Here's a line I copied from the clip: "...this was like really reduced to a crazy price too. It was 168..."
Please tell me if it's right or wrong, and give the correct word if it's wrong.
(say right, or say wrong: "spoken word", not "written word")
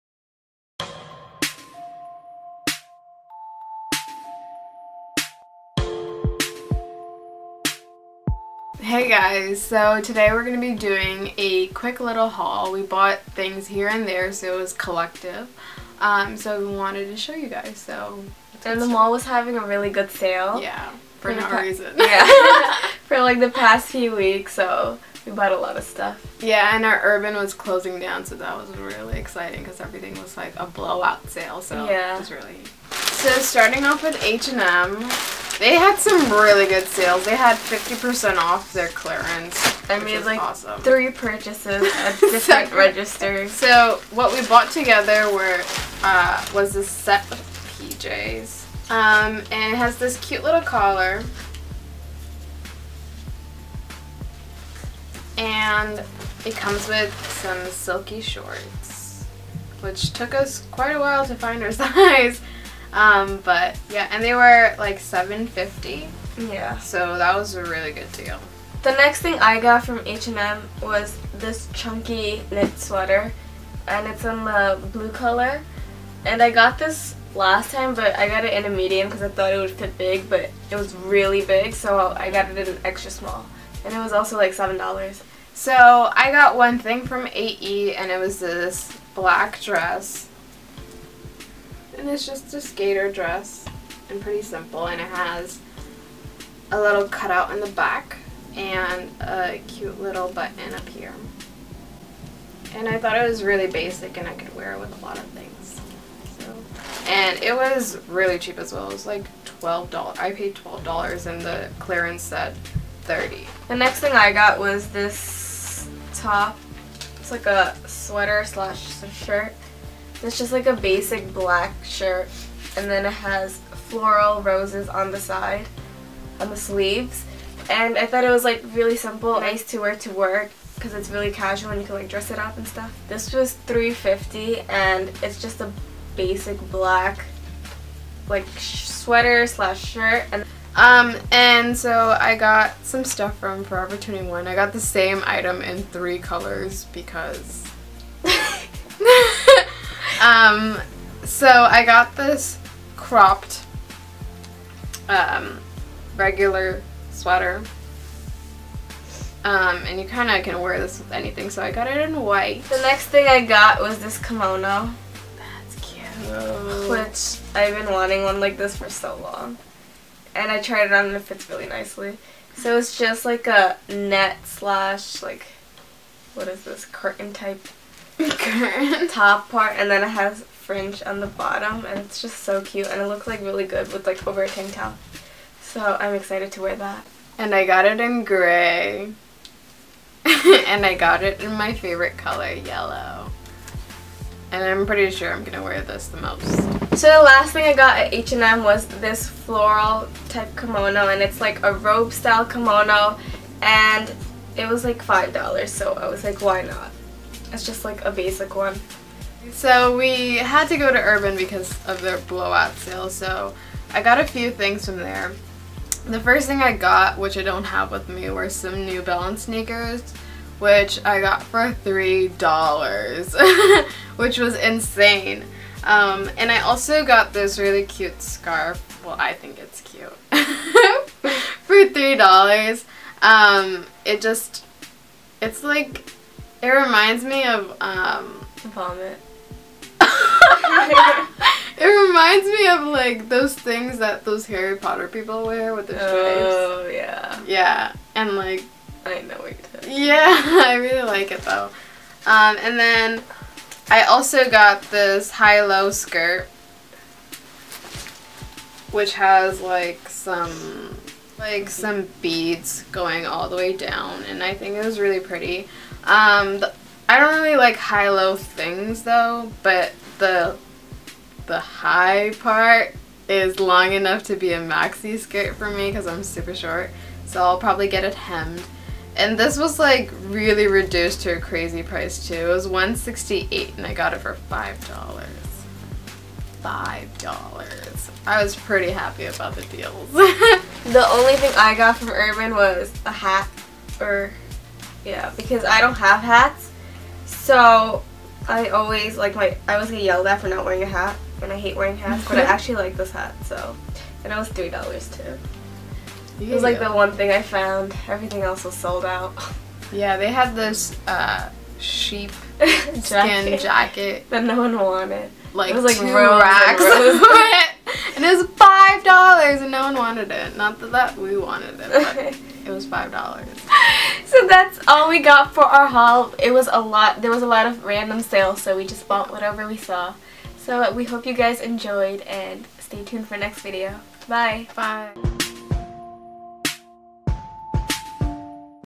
right.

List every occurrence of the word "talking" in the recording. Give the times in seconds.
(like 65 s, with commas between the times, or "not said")
249 s.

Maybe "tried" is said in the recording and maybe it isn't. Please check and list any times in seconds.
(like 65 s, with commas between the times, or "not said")
170 s.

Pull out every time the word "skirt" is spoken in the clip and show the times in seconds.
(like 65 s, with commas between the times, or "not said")
255 s, 275 s.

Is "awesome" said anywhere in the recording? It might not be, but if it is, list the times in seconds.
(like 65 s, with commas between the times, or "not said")
40 s.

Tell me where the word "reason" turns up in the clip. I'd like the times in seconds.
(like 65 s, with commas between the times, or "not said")
21 s.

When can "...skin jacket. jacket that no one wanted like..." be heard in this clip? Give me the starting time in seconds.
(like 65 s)
312 s.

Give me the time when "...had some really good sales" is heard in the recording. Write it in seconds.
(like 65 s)
35 s.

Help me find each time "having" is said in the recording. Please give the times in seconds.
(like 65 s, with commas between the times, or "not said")
19 s.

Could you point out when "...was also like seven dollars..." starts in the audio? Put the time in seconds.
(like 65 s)
83 s.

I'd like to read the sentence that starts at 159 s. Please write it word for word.
Um, and you kind of can wear this with anything, so I got it in white.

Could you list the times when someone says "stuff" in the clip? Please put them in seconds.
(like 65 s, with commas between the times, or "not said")
25 s, 132 s, 143 s.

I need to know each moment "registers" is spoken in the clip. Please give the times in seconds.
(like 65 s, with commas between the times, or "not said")
42 s.